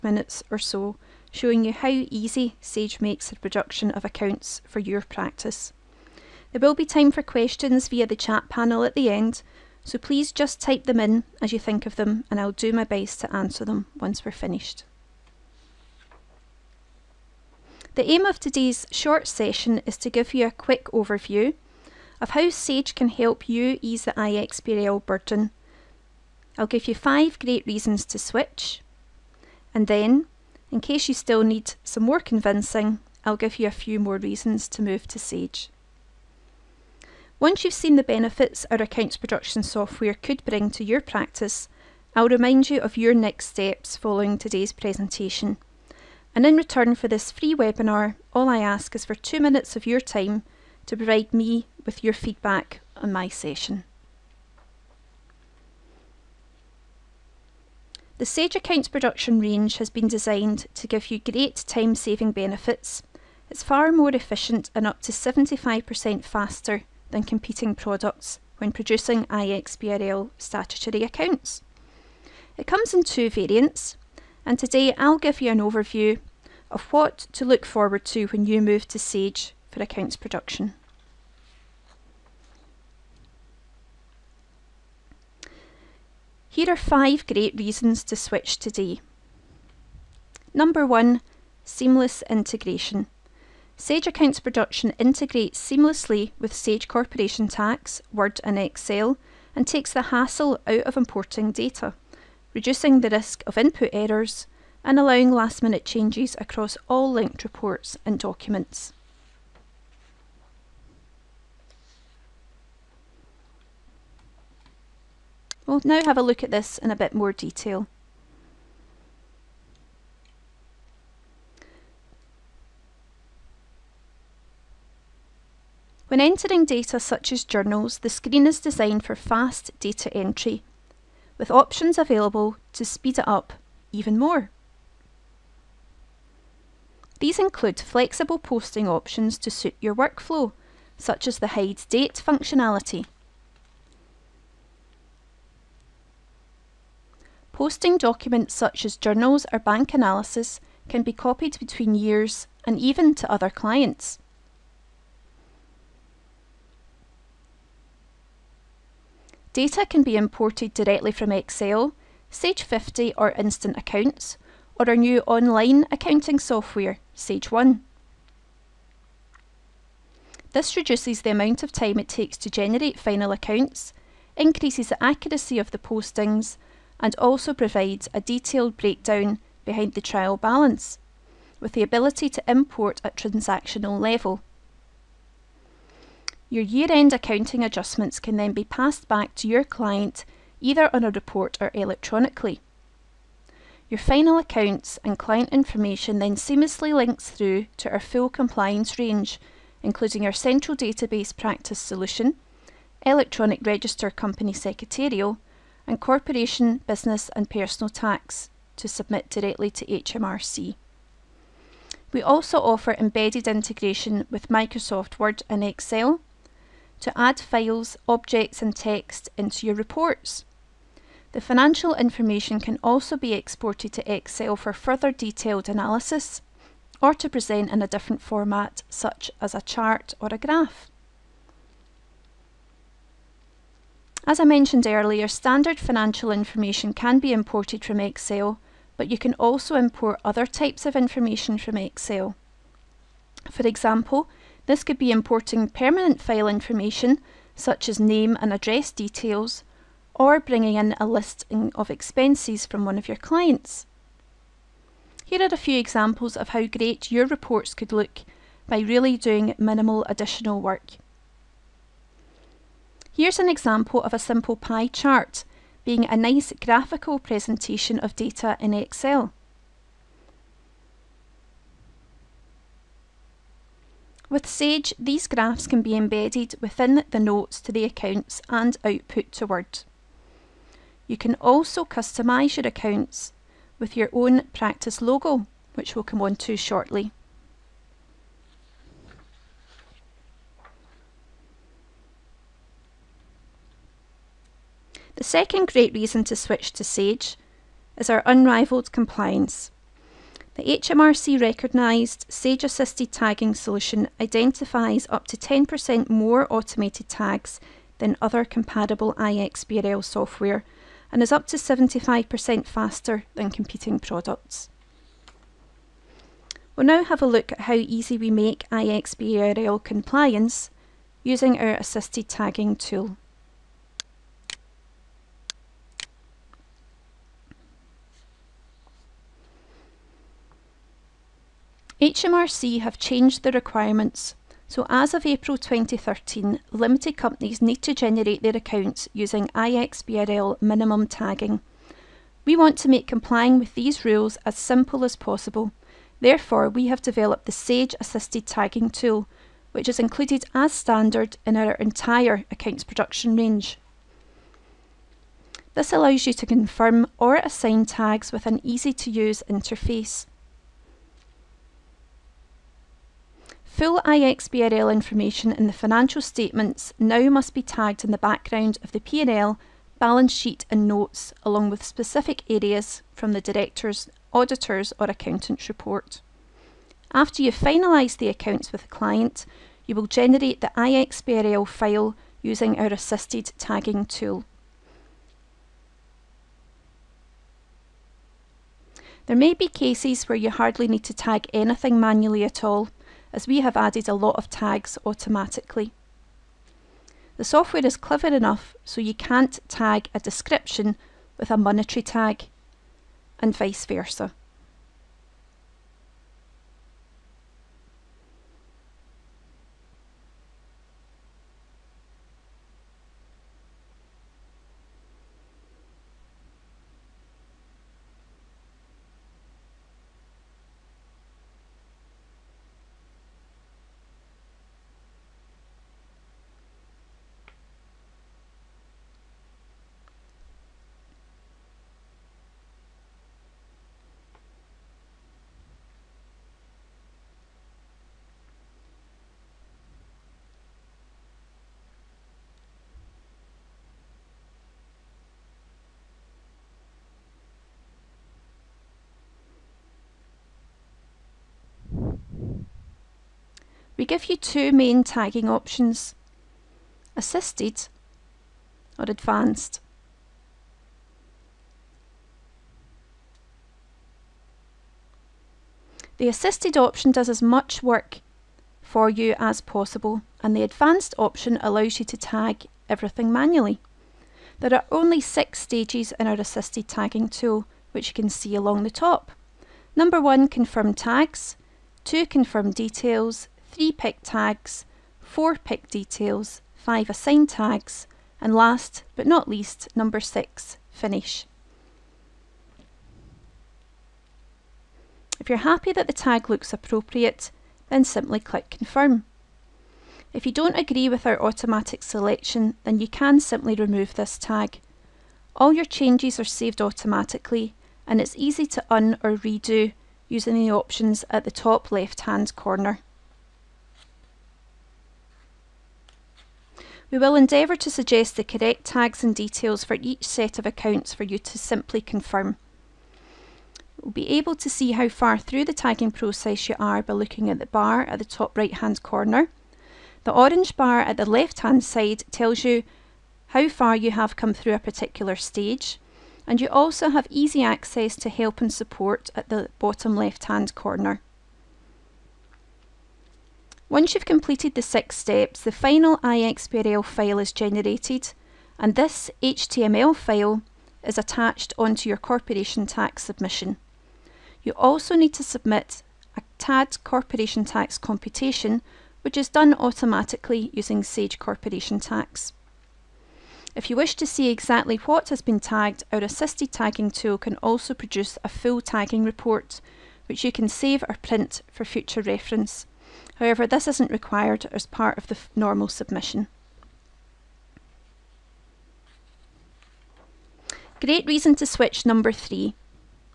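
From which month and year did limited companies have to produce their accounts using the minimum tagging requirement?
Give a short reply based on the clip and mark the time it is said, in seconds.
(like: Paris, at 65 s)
April 2013, at 335 s.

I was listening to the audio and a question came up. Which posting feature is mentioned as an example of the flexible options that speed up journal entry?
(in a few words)
hide date functionality.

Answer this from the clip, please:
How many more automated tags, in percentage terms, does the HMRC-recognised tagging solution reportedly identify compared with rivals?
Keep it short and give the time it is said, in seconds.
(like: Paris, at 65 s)
10%, at 305 s.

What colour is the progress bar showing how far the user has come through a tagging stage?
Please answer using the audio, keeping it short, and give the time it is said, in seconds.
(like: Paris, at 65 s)
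orange, at 530 s.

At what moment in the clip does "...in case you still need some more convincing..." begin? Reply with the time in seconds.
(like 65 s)
30 s.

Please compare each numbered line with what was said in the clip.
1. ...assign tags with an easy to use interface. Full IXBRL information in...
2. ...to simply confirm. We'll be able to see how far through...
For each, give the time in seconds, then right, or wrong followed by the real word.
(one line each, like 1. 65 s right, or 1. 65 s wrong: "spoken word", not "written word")
1. 357 s right
2. 521 s right.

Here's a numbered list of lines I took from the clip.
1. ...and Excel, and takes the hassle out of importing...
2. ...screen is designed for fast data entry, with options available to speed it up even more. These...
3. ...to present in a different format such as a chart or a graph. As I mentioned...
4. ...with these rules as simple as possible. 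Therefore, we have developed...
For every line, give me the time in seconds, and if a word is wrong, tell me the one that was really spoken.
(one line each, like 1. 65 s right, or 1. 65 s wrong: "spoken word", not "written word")
1. 98 s right
2. 128 s right
3. 227 s right
4. 343 s right.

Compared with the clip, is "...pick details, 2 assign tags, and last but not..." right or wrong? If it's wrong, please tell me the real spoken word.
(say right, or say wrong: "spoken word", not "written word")
wrong: "5", not "2".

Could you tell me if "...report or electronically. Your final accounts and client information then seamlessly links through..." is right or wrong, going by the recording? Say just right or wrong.
right.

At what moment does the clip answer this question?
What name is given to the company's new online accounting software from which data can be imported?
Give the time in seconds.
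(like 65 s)
167 s.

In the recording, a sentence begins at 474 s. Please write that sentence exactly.
There are only six stages in our assisted tagging tool which you can see along the top.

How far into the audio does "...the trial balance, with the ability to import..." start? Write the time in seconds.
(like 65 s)
179 s.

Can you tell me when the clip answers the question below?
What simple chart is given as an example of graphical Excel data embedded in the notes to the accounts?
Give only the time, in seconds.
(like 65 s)
264 s.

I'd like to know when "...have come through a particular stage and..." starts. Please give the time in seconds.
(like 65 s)
534 s.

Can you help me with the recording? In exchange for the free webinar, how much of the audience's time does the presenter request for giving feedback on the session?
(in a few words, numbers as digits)
2 minutes.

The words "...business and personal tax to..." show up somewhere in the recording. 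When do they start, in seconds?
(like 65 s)
206 s.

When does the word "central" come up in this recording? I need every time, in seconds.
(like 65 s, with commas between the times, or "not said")
200 s.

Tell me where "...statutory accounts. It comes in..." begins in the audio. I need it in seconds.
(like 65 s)
70 s.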